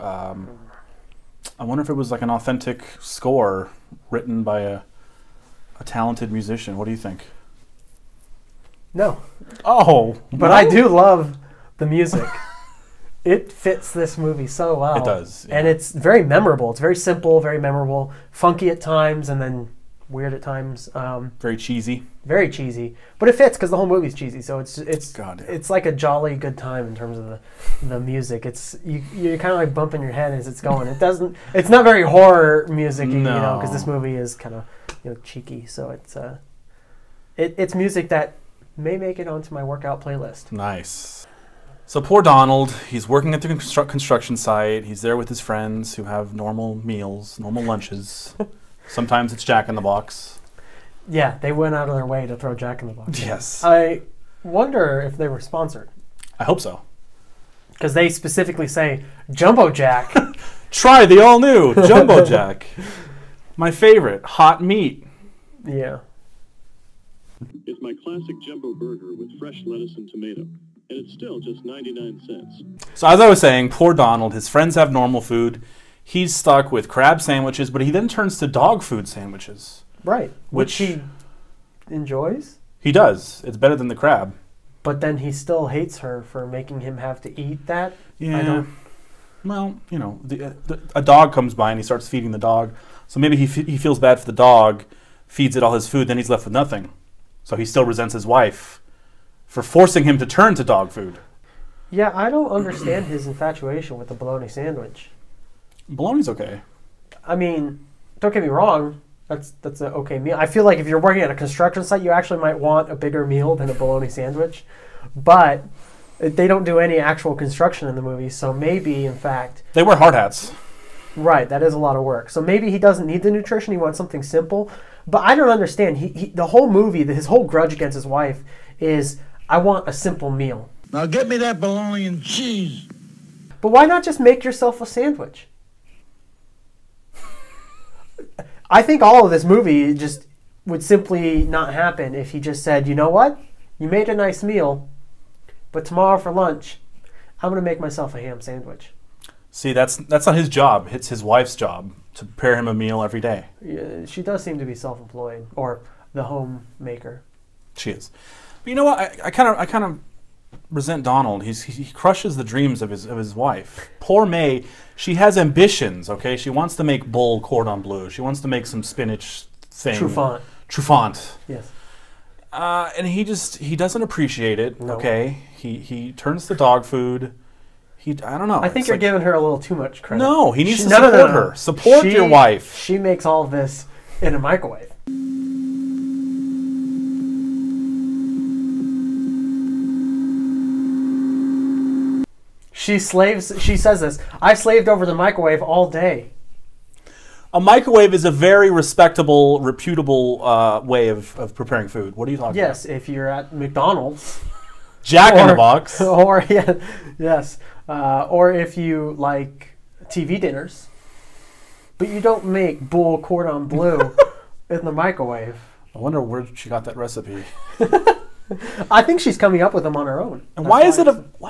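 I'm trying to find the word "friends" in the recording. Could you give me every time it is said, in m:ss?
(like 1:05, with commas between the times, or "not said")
0:45, 1:14.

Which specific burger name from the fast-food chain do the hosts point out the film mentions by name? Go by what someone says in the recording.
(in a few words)
Jumbo Jack.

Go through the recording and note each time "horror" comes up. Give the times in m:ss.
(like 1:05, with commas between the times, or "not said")
0:32.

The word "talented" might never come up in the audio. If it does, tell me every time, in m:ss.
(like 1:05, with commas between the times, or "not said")
0:05.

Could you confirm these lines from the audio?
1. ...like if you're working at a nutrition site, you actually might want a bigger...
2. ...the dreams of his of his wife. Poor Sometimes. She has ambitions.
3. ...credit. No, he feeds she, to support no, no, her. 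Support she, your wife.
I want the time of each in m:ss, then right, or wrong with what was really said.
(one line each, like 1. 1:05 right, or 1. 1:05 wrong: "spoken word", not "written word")
1. 1:50 wrong: "construction", not "nutrition"
2. 2:42 wrong: "May", not "Sometimes"
3. 3:00 wrong: "needs", not "feeds".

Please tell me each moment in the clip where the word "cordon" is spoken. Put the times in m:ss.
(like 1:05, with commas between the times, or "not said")
2:47, 3:33.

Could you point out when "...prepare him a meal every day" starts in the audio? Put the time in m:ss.
2:32.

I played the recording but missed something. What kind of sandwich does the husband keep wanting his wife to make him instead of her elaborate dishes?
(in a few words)
bologna and cheese.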